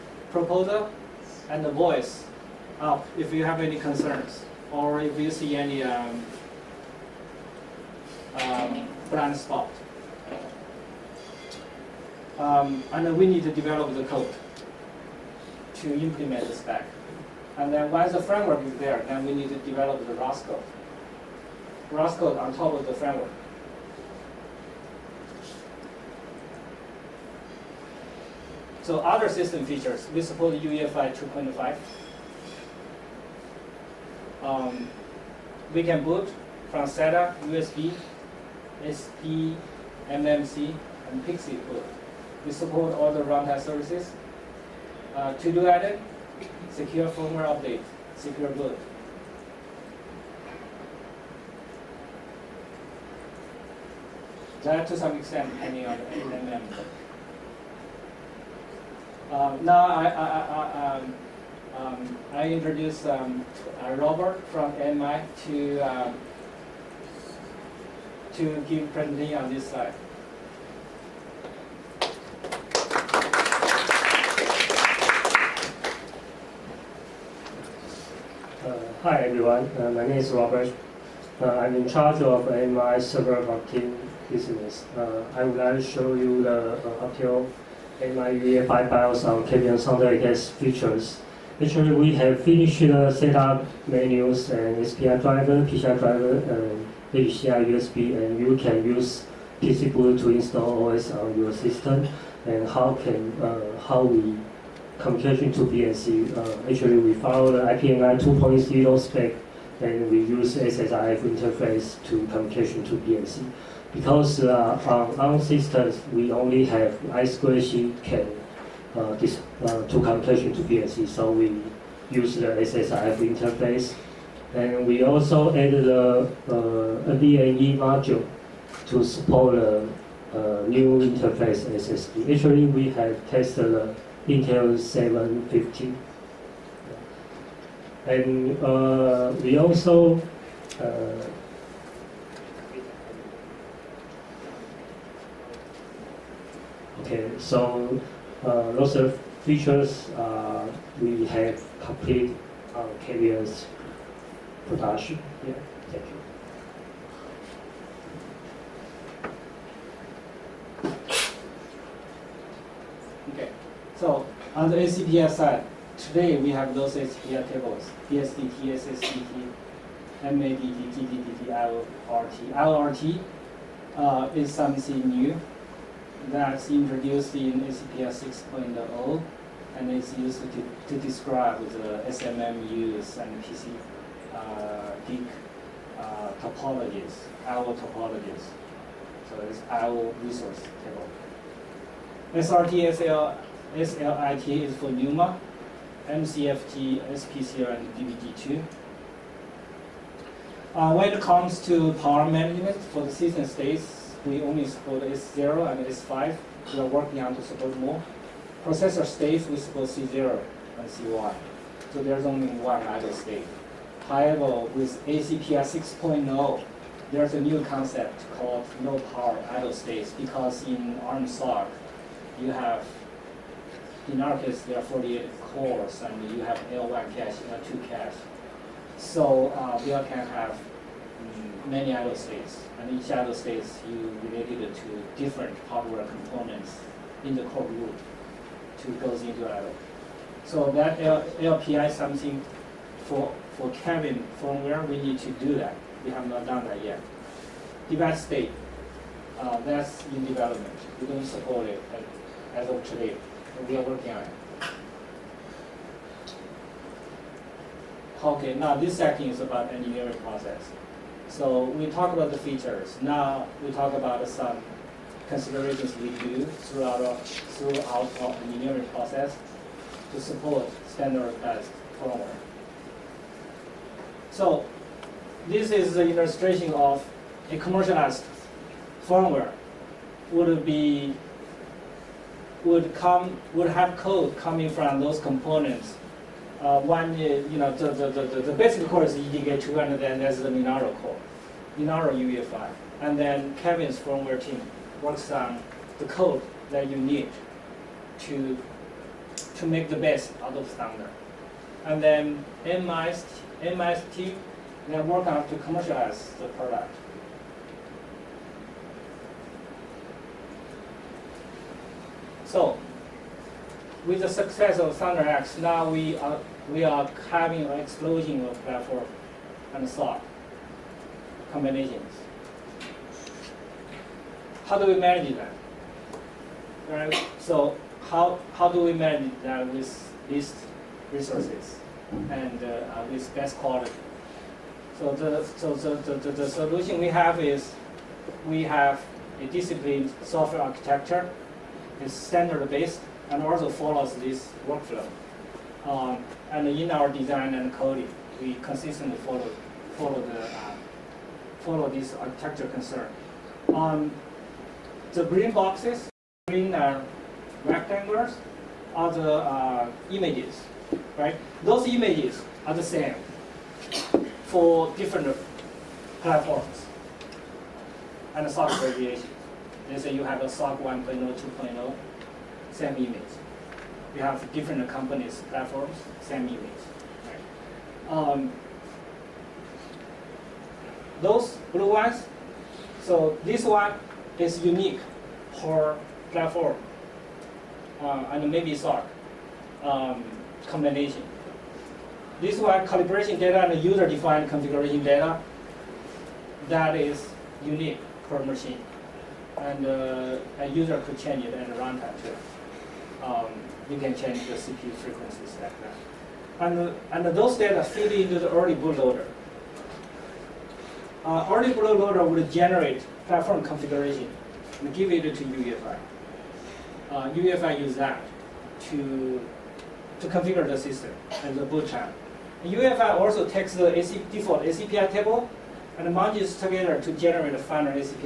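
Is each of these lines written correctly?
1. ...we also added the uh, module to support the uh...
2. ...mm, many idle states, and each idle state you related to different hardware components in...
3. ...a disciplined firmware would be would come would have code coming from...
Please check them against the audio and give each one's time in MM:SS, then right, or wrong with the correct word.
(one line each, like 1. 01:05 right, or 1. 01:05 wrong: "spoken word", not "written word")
1. 02:04 right
2. 03:51 right
3. 04:37 wrong: "commercialized", not "disciplined".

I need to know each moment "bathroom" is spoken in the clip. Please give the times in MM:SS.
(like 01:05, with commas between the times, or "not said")
not said.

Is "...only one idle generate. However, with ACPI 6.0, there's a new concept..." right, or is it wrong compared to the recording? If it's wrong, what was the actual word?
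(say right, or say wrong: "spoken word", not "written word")
wrong: "state", not "generate".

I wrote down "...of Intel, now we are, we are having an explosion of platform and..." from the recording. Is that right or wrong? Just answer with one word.
wrong.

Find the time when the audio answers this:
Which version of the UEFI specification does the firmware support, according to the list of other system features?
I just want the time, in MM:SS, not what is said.
00:30.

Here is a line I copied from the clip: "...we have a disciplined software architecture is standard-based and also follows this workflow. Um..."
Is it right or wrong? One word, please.
right.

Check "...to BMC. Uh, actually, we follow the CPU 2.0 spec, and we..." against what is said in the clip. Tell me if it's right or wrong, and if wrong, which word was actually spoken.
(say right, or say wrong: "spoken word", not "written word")
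wrong: "IPMI", not "CPU".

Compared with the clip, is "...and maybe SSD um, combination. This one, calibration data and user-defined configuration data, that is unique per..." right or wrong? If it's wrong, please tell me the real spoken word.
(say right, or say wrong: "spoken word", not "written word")
wrong: "SOC", not "SSD".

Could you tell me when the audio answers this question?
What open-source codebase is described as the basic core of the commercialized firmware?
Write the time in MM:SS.
04:49.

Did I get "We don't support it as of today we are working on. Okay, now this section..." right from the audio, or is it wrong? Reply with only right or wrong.
right.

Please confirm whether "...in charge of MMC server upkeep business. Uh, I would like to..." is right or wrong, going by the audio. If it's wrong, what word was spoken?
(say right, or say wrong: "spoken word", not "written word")
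wrong: "AMI", not "MMC".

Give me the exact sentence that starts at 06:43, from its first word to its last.
Um, you can change the CPU frequencies like that.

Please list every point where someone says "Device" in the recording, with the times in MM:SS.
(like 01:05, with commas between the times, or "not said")
04:07.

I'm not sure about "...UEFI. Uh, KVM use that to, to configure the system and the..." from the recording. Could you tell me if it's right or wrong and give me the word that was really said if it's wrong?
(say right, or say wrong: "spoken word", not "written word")
wrong: "UEFI", not "KVM".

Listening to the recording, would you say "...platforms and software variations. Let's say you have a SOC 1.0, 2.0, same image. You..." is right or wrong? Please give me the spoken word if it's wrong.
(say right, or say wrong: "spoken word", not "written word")
right.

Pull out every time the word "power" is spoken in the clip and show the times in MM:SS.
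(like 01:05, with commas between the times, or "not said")
03:21, 03:39.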